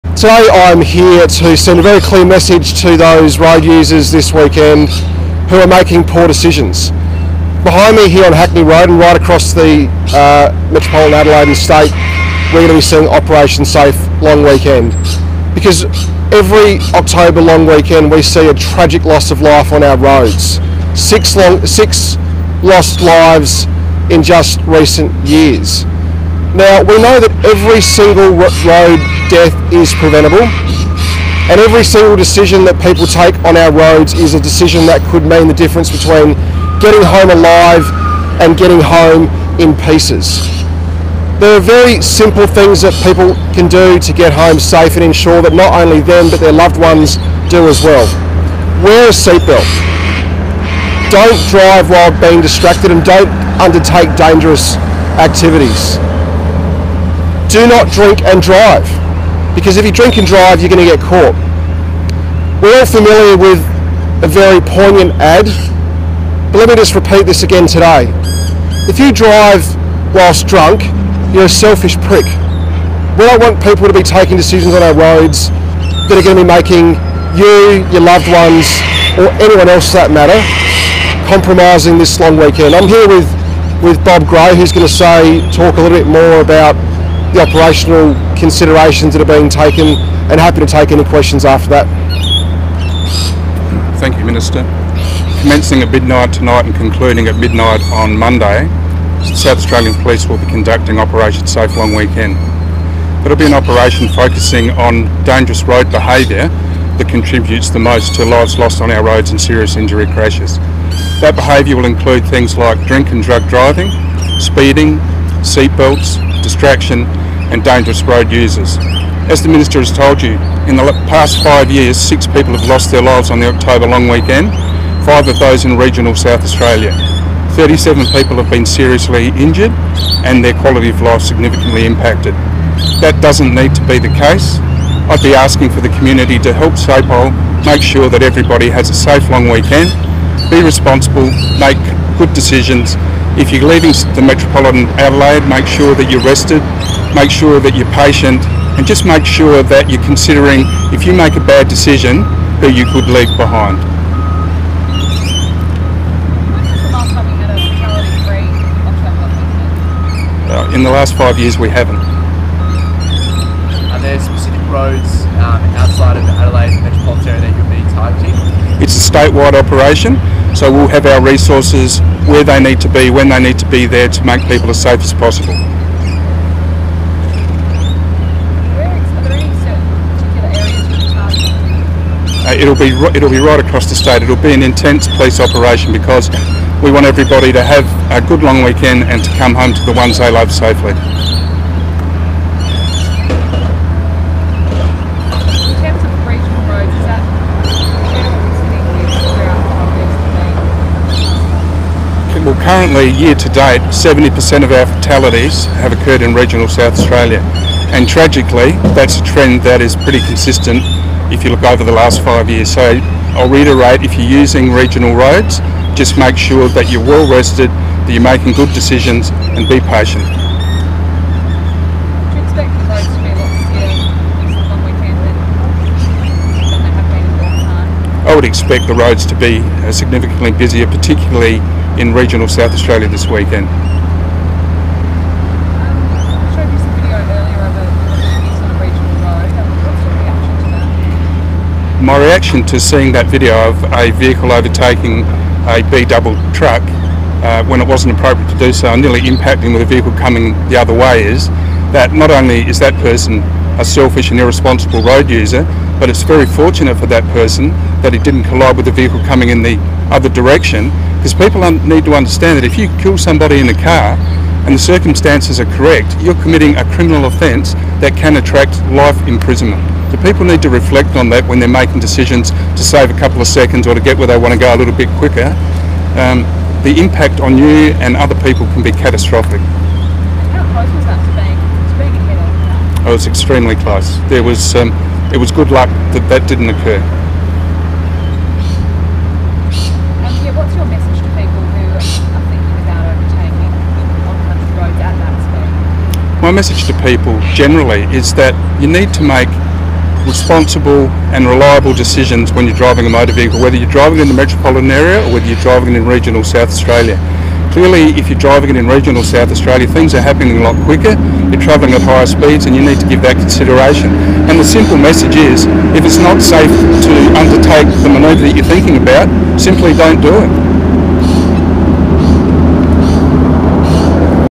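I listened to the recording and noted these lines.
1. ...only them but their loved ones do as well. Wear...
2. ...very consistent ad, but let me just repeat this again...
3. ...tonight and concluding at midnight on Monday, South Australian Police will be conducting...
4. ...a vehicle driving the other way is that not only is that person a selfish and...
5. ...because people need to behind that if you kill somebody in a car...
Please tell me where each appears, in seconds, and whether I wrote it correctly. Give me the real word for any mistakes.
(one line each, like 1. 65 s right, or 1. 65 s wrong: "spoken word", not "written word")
1. 45 s right
2. 64 s wrong: "poignant", not "consistent"
3. 96 s right
4. 249 s wrong: "coming", not "driving"
5. 261 s wrong: "understand", not "behind".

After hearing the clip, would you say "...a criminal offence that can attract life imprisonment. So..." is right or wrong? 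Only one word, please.
right.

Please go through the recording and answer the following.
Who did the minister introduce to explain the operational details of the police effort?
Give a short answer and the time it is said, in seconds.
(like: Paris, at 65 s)
Bob Gray, at 84 s.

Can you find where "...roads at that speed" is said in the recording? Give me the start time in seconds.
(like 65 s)
294 s.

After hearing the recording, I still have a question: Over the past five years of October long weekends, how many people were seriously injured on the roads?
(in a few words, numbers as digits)
37.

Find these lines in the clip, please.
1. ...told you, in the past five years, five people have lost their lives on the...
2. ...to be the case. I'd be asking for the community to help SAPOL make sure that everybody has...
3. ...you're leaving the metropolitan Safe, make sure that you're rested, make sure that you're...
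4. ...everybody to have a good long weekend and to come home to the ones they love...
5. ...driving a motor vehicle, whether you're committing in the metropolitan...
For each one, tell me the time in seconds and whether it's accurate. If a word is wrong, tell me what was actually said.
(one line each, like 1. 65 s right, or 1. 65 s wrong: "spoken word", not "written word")
1. 119 s wrong: "six", not "five"
2. 133 s right
3. 143 s wrong: "Adelaide", not "Safe"
4. 187 s right
5. 302 s wrong: "driving", not "committing".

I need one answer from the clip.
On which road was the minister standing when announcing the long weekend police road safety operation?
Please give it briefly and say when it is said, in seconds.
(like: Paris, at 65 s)
Hackney Road, at 8 s.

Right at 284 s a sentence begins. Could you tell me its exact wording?
There was, um, it was good luck that that didn't occur.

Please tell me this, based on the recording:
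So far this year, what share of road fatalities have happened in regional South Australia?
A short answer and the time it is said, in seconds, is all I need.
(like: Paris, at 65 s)
70%, at 203 s.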